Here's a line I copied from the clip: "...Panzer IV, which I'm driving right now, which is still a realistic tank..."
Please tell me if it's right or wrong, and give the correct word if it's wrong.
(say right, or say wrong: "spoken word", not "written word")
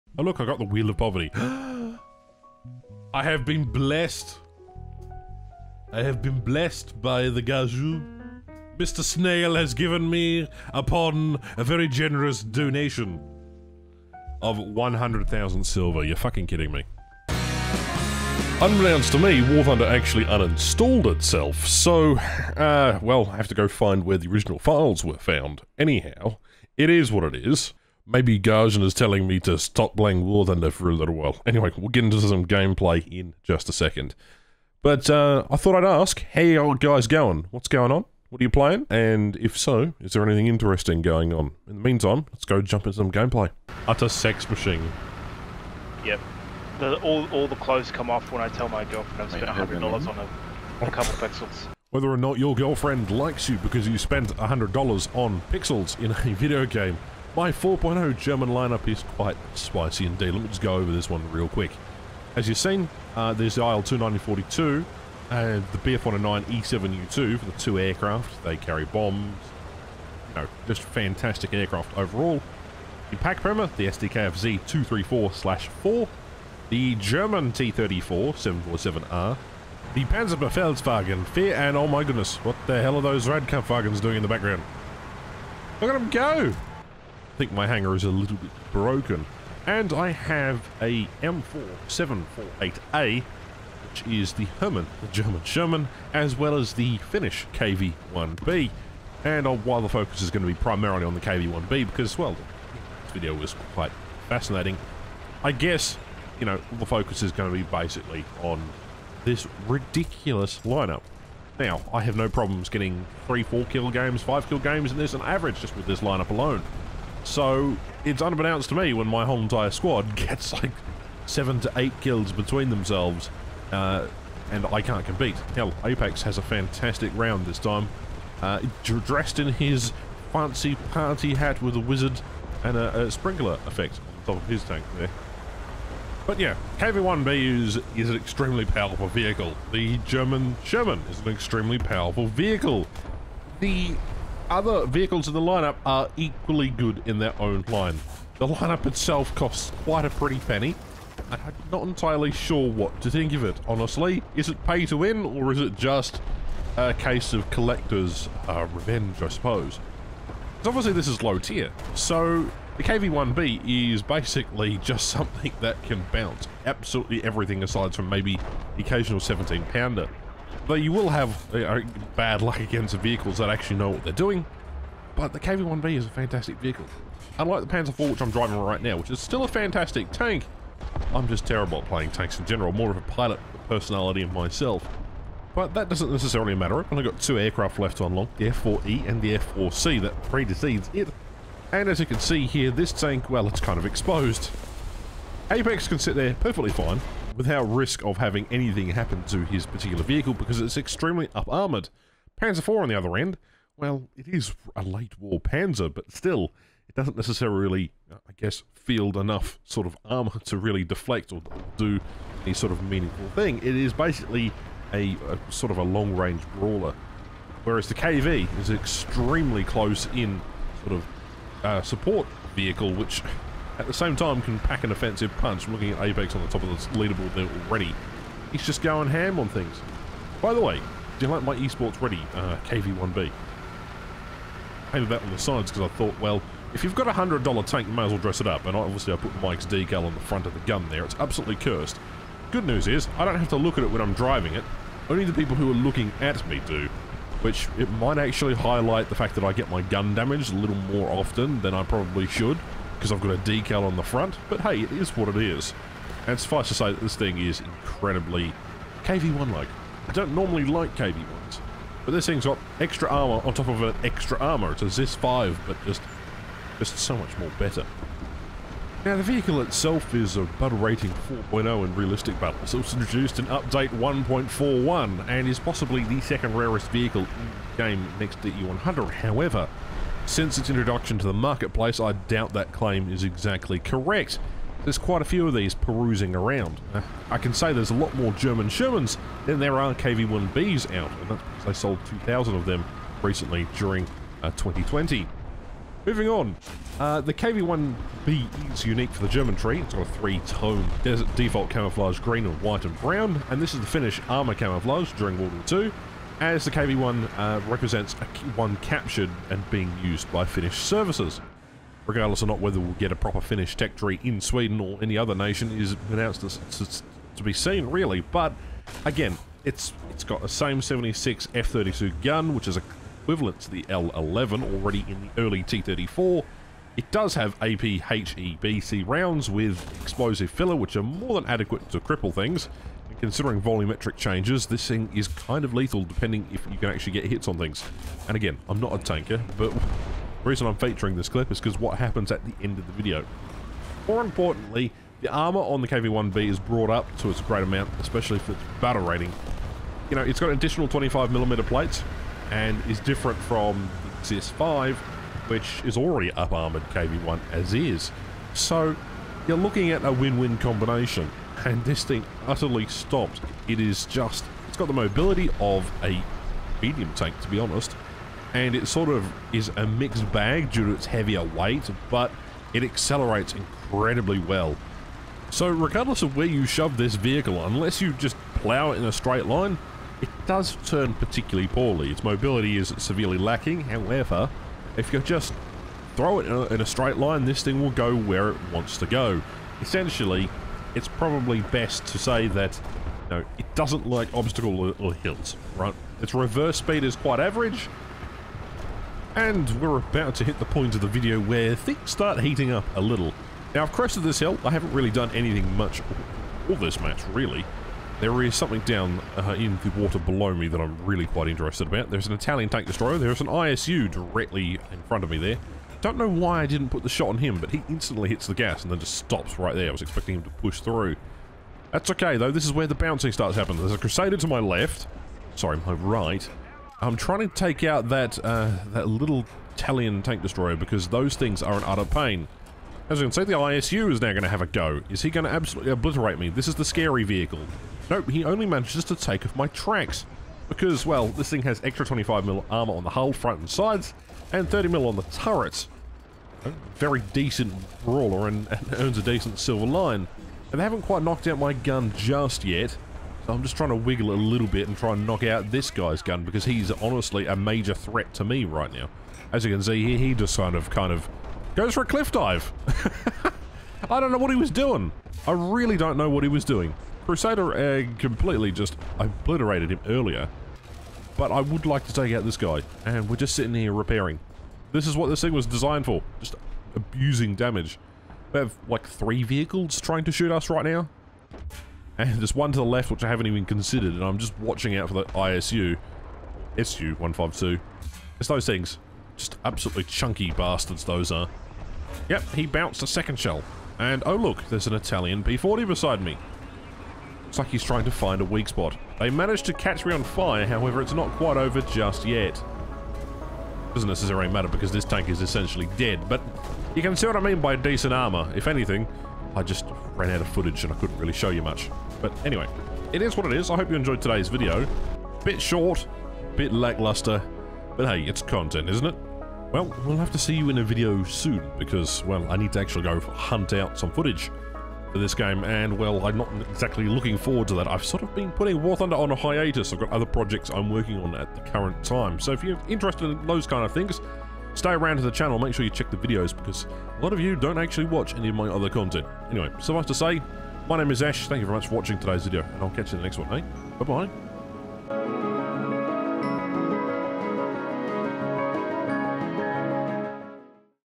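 wrong: "fantastic", not "realistic".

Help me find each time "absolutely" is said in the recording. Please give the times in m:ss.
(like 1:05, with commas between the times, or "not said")
2:46, 4:01, 7:15, 8:09.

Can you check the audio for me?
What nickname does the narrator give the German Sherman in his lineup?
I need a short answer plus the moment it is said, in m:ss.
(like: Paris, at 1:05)
Hermann, at 1:34.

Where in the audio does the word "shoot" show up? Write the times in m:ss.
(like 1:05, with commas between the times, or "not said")
8:00.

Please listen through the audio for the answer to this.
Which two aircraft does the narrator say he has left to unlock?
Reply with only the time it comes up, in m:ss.
3:08.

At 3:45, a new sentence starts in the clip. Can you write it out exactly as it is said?
I'm looking at Apex on the top of the leaderboard there already.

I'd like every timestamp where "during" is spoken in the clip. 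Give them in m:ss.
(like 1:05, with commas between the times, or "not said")
4:53, 5:05.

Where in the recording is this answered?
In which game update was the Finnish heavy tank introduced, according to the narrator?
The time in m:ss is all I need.
4:33.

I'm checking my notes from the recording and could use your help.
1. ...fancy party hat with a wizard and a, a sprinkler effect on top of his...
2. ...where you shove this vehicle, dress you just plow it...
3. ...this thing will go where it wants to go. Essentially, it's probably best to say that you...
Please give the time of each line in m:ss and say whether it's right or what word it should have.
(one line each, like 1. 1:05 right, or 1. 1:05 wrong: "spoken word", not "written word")
1. 2:10 right
2. 6:16 wrong: "unless", not "dress"
3. 6:27 right.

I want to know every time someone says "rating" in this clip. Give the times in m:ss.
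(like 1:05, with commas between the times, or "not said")
4:30, 5:49.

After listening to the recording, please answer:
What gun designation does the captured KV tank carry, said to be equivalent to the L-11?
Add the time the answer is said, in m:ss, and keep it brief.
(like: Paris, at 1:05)
76 F-32, at 5:20.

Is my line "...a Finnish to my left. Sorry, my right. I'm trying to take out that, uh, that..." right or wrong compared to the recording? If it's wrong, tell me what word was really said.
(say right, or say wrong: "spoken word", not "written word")
wrong: "Crusader", not "Finnish".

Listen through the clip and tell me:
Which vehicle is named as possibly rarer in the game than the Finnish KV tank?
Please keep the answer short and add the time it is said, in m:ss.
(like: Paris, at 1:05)
E100, at 4:38.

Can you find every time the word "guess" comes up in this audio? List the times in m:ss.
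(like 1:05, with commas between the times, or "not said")
1:45, 3:28.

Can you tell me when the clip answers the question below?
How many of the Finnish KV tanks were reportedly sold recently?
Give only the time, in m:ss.
4:52.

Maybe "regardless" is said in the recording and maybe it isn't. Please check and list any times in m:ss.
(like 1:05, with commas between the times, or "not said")
5:12, 6:15.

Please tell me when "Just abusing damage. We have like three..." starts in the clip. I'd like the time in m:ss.
7:56.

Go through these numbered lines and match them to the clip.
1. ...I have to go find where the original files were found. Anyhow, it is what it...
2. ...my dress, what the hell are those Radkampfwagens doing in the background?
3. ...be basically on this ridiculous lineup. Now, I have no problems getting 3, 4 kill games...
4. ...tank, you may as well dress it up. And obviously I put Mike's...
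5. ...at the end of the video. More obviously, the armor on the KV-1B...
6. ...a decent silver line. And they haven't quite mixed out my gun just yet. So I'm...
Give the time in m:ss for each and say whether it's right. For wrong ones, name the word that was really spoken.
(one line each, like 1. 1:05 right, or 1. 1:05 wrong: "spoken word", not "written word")
1. 0:23 right
2. 1:21 wrong: "goodness", not "dress"
3. 1:47 right
4. 3:57 right
5. 5:42 wrong: "importantly", not "obviously"
6. 7:29 wrong: "knocked", not "mixed".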